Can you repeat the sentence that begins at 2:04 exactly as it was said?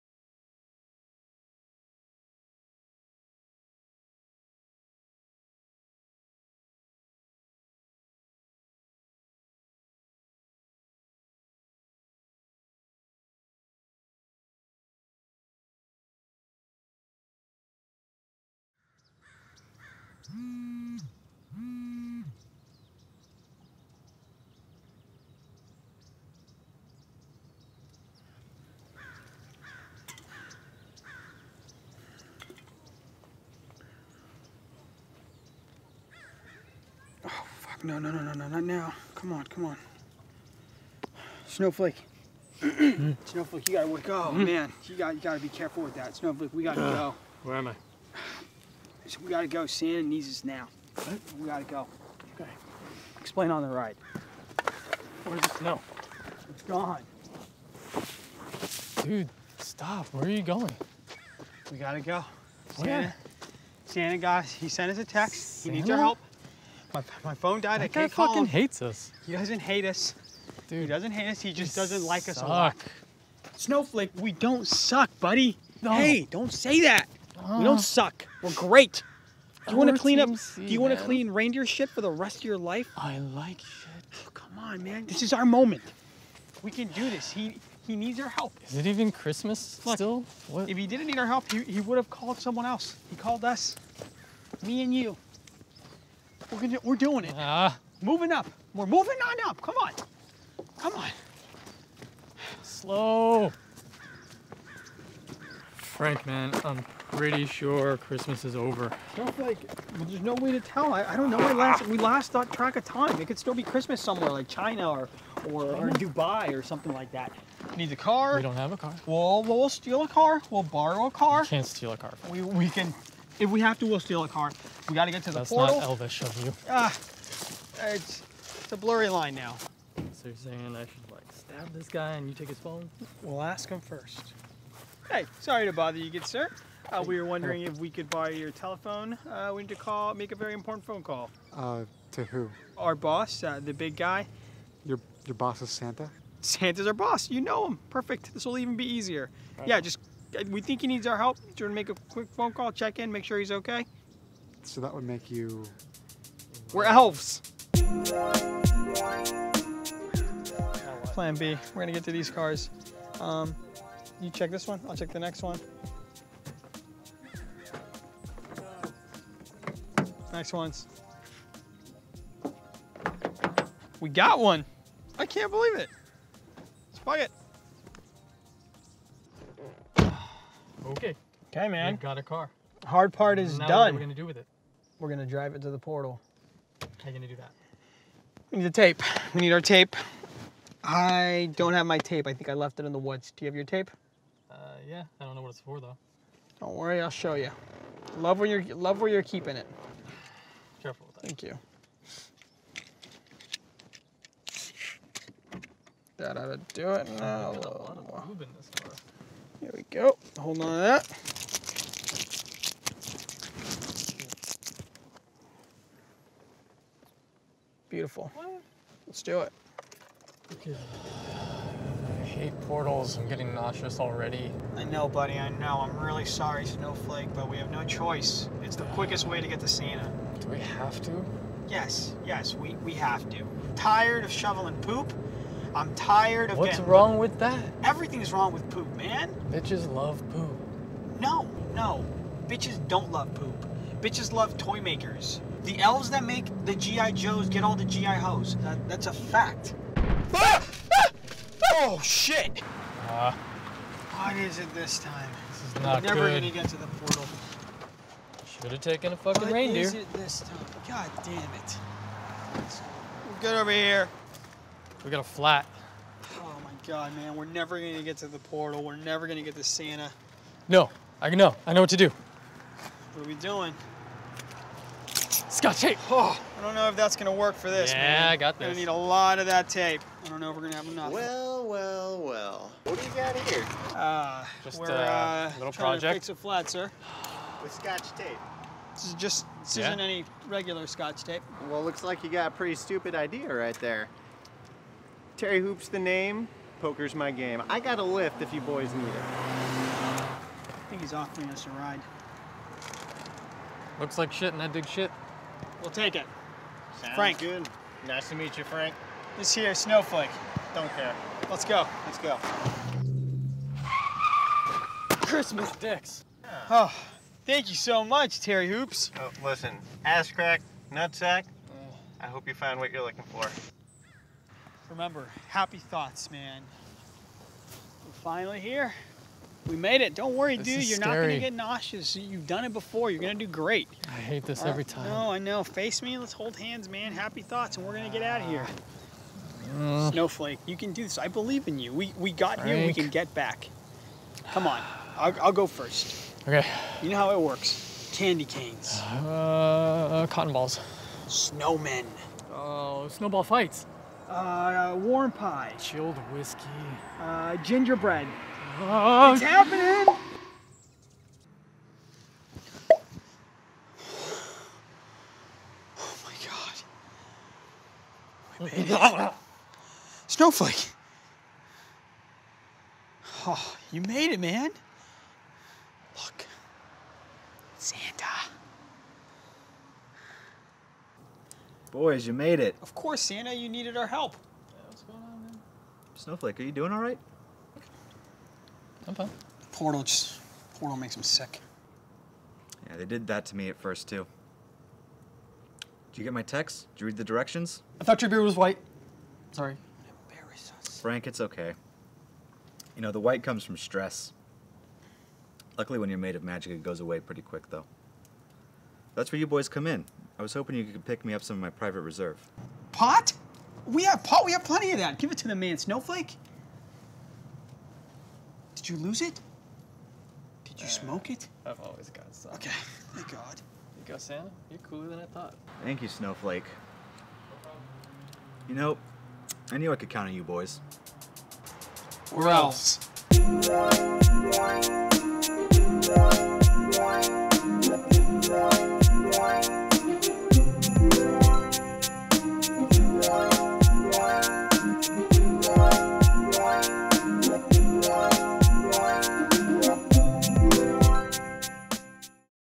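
We got to get to the That's portal.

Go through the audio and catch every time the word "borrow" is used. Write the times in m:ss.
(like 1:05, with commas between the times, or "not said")
2:00, 2:18.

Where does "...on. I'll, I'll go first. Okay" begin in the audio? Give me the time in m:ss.
5:44.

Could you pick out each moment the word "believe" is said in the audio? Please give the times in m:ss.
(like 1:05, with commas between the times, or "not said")
2:55, 5:41.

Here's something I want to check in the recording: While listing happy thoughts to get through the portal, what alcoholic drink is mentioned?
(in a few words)
Chilled whiskey.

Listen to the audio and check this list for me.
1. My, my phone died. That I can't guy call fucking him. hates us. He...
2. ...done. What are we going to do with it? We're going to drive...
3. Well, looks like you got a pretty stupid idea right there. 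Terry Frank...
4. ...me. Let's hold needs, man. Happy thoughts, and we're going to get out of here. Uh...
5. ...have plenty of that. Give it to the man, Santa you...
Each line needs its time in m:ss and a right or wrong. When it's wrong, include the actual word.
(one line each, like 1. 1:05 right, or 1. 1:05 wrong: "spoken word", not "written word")
1. 1:06 right
2. 3:03 right
3. 4:51 wrong: "Hoopes", not "Frank"
4. 5:36 wrong: "hands", not "needs"
5. 6:54 wrong: "Snowflake", not "Santa".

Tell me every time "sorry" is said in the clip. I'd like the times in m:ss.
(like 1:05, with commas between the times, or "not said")
2:15, 3:46, 6:39.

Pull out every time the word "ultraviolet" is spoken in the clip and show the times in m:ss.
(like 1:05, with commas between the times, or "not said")
not said.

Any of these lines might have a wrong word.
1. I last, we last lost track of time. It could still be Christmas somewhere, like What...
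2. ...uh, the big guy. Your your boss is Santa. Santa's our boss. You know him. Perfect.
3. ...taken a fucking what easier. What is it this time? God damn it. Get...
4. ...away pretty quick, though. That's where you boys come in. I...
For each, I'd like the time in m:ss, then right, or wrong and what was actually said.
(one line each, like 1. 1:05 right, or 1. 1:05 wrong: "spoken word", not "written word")
1. 1:51 wrong: "China", not "What"
2. 2:23 right
3. 4:18 wrong: "reindeer", not "easier"
4. 6:46 right.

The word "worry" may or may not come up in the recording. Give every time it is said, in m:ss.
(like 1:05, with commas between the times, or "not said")
3:16, 5:30.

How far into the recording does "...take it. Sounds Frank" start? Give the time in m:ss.
5:05.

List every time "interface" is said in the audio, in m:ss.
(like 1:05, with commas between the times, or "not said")
not said.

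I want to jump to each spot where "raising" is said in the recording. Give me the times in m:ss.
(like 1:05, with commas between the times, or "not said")
not said.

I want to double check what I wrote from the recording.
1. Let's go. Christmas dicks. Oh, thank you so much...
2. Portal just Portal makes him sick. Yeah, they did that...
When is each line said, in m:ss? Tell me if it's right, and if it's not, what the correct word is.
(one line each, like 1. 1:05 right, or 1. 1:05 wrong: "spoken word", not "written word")
1. 5:12 right
2. 6:29 right.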